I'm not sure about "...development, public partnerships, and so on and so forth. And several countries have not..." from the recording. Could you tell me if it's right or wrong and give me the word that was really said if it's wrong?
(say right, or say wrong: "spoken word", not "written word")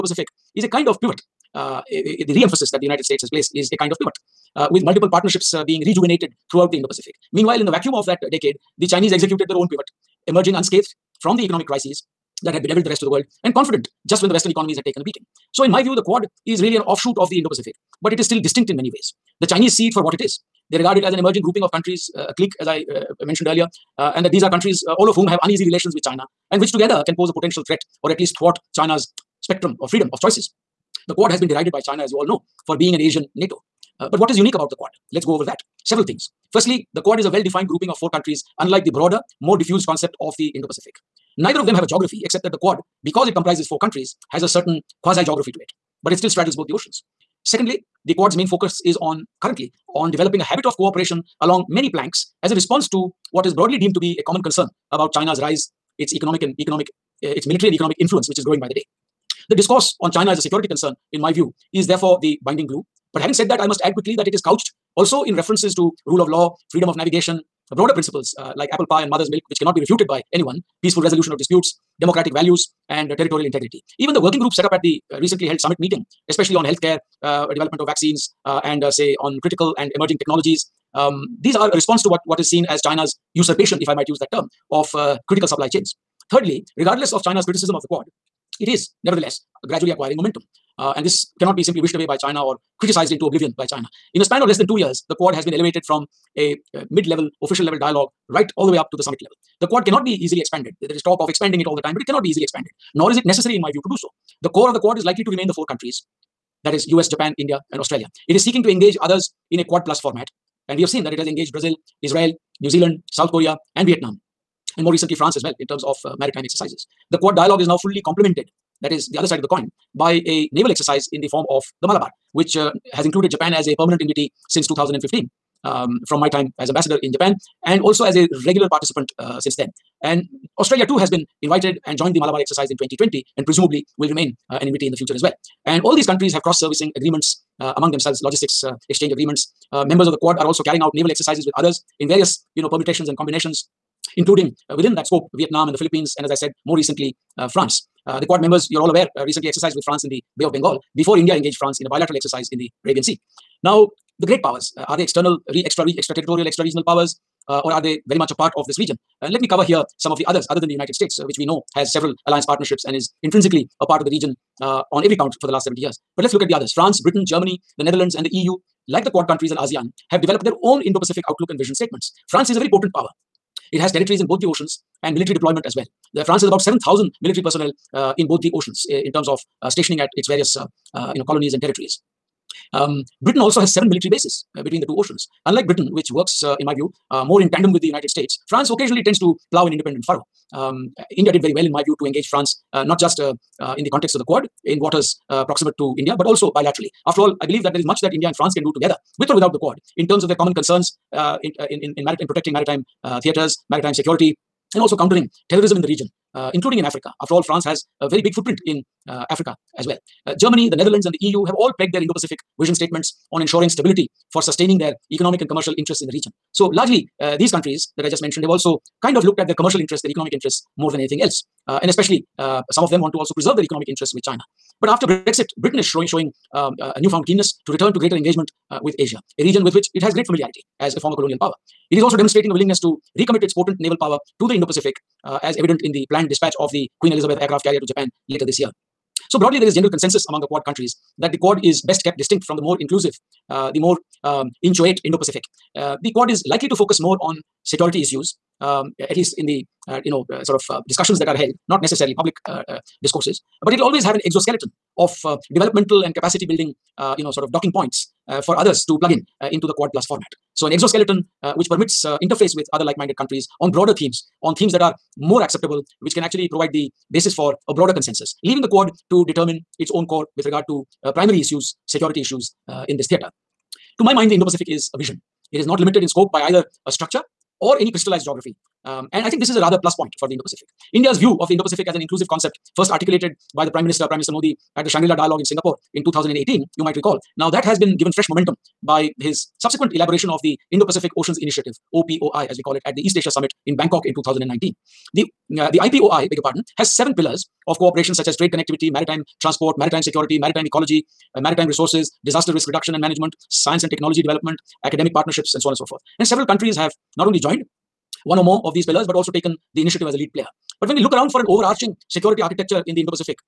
wrong: "academic", not "public".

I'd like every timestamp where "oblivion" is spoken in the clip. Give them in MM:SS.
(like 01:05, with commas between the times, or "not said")
01:33.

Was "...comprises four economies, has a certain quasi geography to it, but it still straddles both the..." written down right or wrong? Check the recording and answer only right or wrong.
wrong.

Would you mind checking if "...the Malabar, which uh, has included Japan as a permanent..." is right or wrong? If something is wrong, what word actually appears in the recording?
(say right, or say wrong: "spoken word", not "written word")
right.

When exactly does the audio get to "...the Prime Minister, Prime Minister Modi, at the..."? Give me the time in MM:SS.
04:43.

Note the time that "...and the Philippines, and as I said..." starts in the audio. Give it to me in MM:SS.
02:25.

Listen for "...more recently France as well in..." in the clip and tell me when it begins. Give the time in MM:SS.
01:54.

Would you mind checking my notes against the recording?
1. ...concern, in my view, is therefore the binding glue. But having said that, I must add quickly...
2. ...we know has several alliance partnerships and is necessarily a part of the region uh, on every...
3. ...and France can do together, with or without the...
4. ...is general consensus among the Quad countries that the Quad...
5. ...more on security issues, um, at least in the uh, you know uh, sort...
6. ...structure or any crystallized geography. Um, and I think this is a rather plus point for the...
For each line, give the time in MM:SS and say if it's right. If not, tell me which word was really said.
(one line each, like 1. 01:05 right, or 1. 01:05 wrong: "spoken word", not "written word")
1. 01:00 right
2. 02:41 wrong: "intrinsically", not "necessarily"
3. 03:18 right
4. 03:59 right
5. 04:07 right
6. 04:36 right.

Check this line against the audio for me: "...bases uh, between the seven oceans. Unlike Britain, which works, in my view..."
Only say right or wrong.
wrong.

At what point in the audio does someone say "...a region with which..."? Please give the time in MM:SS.
03:49.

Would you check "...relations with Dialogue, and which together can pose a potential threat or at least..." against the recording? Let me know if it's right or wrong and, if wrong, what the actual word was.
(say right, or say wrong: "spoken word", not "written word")
wrong: "China", not "Dialogue".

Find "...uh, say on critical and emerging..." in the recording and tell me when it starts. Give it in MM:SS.
01:18.